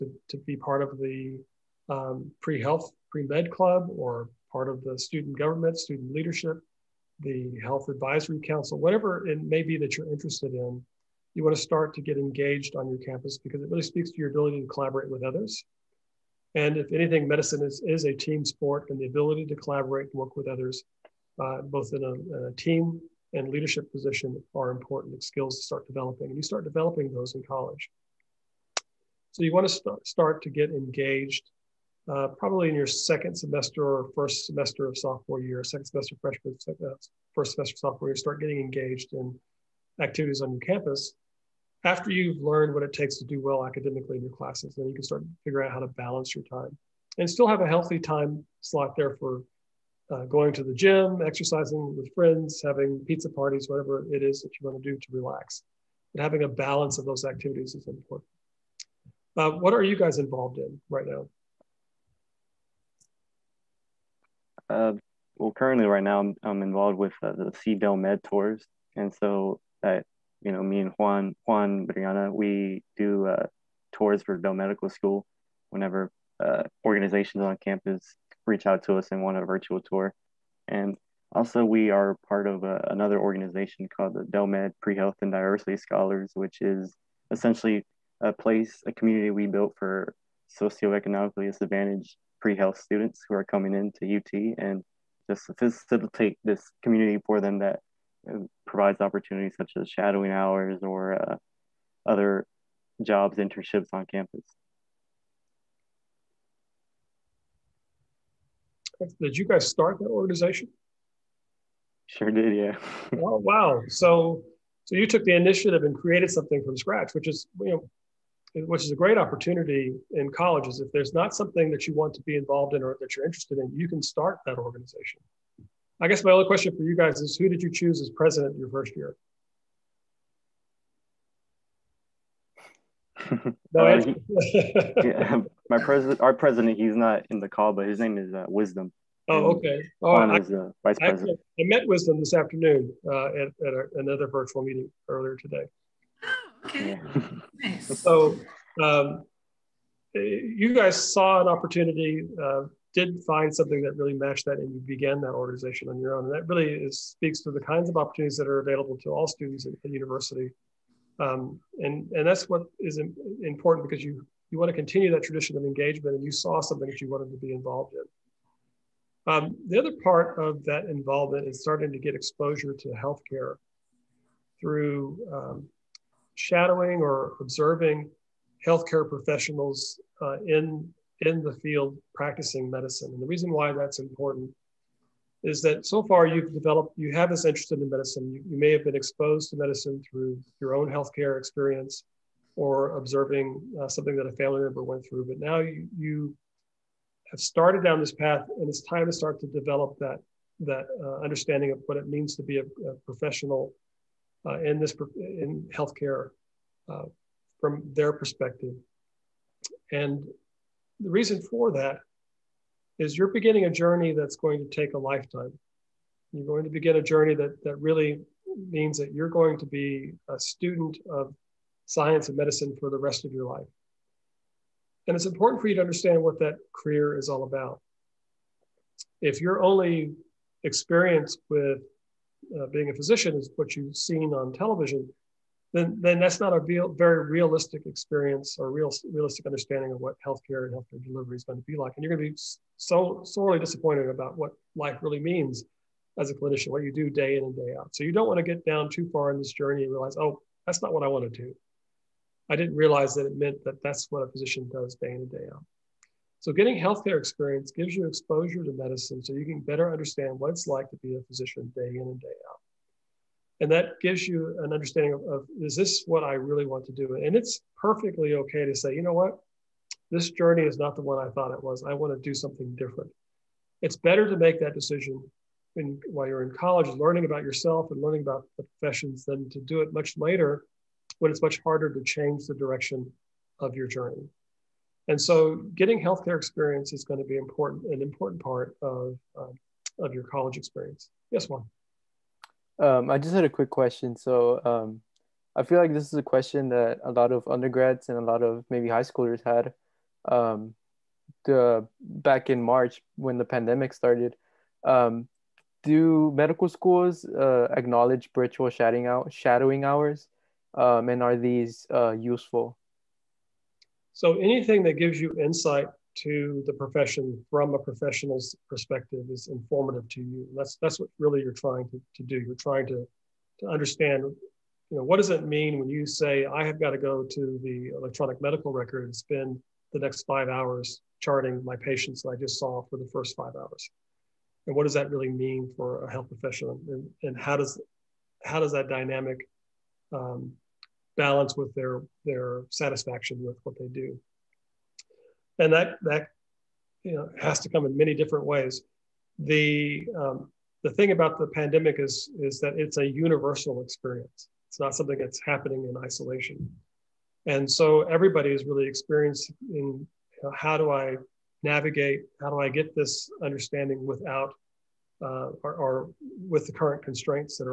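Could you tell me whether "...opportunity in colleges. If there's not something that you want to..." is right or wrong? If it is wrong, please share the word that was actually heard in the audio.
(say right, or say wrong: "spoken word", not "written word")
right.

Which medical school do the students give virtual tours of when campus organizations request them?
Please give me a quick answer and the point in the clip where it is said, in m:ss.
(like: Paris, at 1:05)
Dell Medical School, at 1:14.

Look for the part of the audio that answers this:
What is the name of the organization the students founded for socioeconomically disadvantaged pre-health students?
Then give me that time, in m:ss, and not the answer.
1:24.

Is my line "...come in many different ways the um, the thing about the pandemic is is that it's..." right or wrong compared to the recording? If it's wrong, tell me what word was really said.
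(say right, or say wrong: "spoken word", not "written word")
right.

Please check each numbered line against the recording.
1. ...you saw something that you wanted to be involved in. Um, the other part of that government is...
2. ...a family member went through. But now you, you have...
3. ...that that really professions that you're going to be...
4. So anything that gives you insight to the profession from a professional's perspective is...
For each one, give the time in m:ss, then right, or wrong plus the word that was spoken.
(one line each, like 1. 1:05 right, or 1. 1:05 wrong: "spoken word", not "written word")
1. 2:46 wrong: "involvement", not "government"
2. 3:14 right
3. 3:37 wrong: "means", not "professions"
4. 5:14 right.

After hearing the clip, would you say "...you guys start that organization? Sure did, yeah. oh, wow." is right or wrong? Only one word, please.
right.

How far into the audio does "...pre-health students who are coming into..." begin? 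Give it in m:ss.
1:32.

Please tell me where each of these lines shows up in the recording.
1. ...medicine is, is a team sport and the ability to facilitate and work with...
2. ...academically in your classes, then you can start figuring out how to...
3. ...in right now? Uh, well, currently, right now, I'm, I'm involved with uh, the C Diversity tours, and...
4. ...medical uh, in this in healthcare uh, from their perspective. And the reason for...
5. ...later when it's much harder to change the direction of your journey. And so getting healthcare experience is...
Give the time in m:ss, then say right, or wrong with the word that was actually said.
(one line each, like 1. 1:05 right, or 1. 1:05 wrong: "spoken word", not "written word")
1. 0:17 wrong: "collaborate", not "facilitate"
2. 0:43 right
3. 1:00 wrong: "Med", not "Diversity"
4. 3:23 wrong: "professional", not "medical"
5. 4:40 right.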